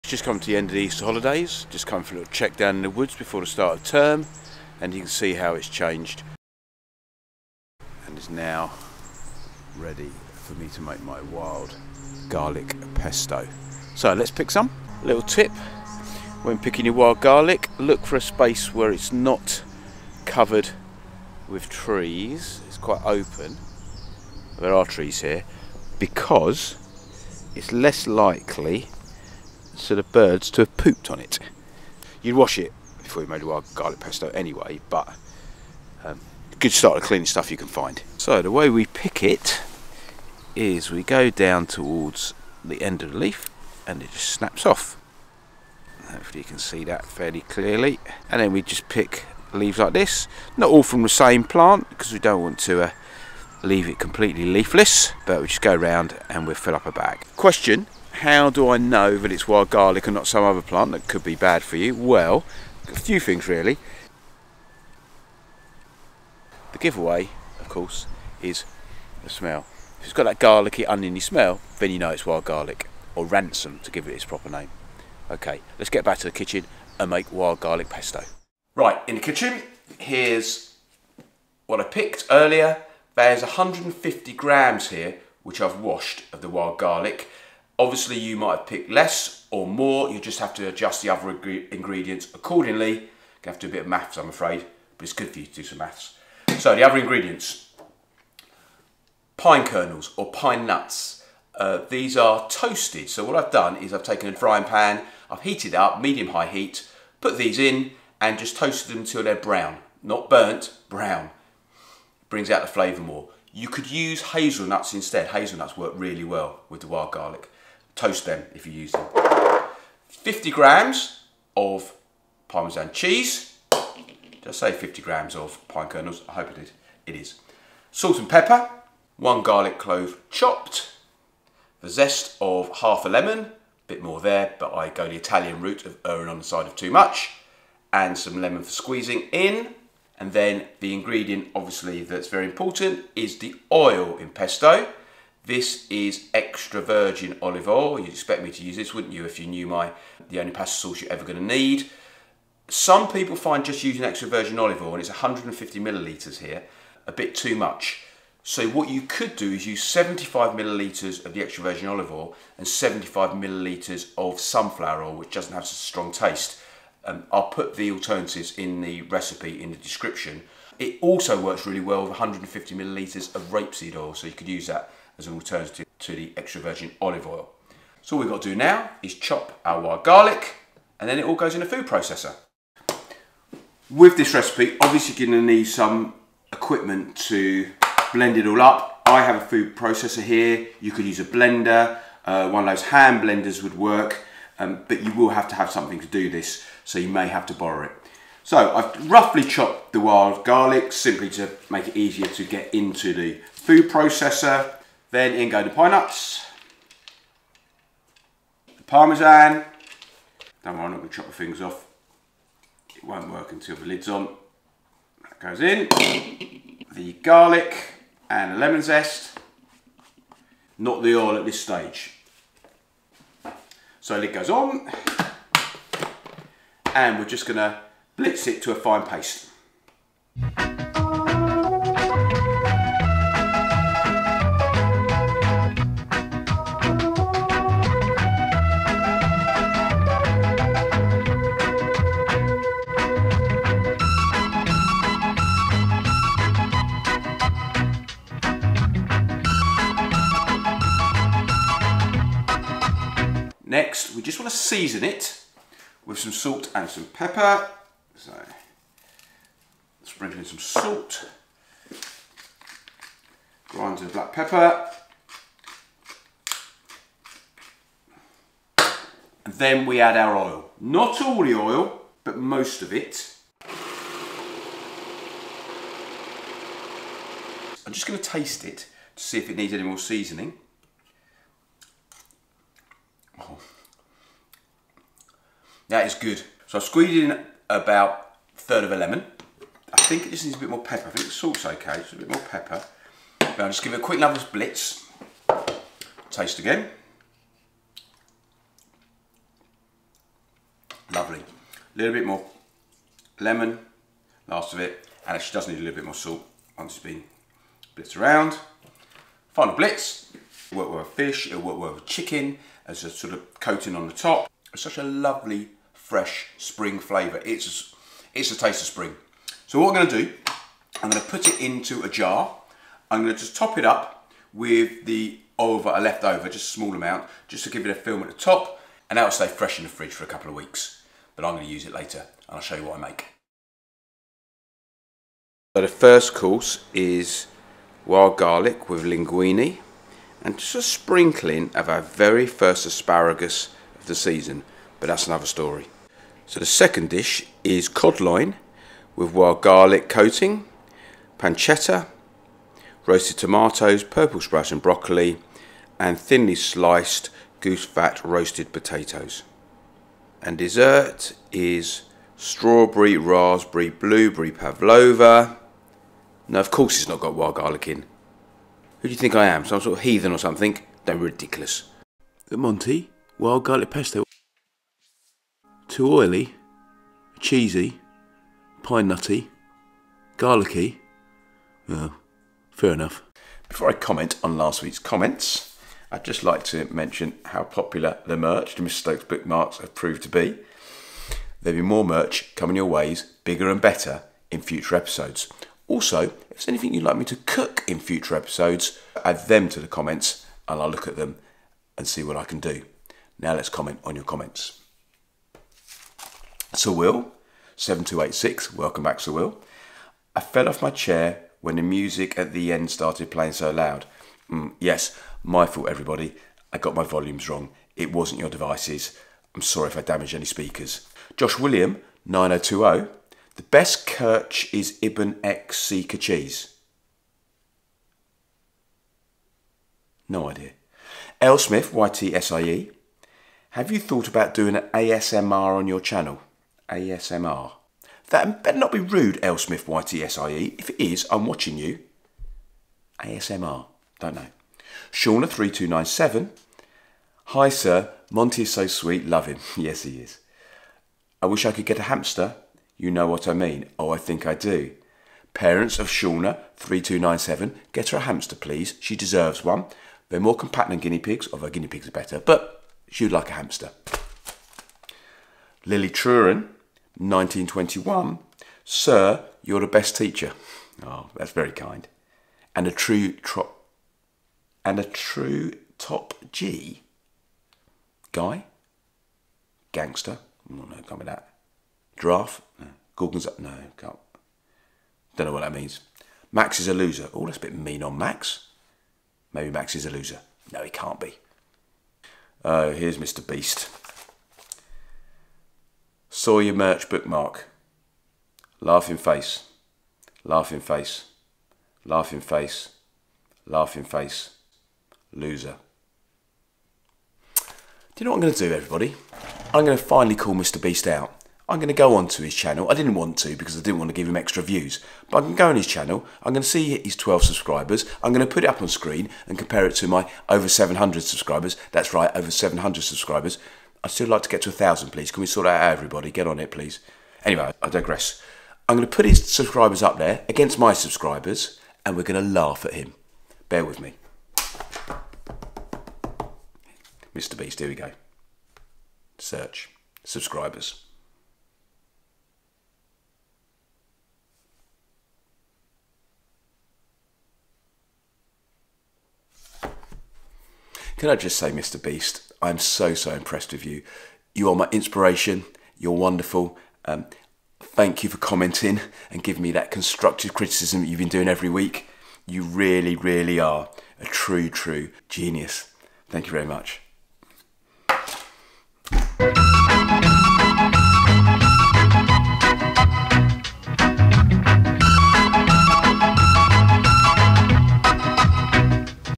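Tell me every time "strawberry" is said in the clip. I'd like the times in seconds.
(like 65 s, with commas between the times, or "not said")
362 s.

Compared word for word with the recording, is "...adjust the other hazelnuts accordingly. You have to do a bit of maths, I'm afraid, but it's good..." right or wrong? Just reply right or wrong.
wrong.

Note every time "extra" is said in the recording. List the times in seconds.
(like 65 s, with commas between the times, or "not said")
146 s, 154 s, 161 s, 176 s, 514 s.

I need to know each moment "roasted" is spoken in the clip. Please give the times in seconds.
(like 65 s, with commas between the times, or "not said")
353 s, 358 s.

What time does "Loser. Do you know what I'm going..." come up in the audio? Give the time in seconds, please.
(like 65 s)
505 s.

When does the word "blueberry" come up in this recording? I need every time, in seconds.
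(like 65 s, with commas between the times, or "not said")
363 s.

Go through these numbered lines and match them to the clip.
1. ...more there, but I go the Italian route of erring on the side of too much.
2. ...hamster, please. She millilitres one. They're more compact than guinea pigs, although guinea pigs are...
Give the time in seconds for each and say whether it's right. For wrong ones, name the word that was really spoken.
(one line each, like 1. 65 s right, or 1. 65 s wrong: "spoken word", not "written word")
1. 134 s right
2. 458 s wrong: "deserves", not "millilitres".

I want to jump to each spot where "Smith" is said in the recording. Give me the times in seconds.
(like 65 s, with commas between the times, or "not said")
431 s, 439 s.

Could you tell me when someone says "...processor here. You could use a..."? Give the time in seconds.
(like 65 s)
189 s.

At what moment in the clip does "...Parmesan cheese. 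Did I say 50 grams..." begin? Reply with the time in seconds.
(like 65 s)
122 s.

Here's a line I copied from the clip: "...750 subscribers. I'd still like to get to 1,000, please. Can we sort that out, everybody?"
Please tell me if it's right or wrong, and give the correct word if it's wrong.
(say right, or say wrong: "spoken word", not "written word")
wrong: "700", not "750".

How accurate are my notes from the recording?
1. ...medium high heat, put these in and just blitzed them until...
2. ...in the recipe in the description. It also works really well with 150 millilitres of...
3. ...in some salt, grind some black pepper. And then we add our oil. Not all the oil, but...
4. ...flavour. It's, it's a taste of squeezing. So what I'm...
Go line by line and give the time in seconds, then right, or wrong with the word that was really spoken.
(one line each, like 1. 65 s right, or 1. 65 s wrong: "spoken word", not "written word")
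1. 106 s wrong: "toasted", not "blitzed"
2. 168 s right
3. 260 s right
4. 316 s wrong: "spring", not "squeezing".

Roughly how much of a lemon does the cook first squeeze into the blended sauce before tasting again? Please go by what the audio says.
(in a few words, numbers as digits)
A third.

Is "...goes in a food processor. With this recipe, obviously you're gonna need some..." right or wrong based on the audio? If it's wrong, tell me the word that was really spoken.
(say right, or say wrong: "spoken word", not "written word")
right.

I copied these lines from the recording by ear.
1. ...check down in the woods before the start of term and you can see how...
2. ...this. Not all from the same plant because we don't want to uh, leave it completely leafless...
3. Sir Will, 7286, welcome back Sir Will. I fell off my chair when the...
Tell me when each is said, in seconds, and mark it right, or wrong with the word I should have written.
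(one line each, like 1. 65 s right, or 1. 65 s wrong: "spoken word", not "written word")
1. 2 s right
2. 49 s right
3. 406 s right.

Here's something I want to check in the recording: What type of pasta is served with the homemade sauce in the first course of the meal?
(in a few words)
Linguine.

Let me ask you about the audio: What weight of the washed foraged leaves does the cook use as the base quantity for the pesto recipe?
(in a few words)
150 grams.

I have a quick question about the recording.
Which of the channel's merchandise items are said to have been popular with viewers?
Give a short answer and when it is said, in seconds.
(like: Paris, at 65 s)
Bookmarks, at 389 s.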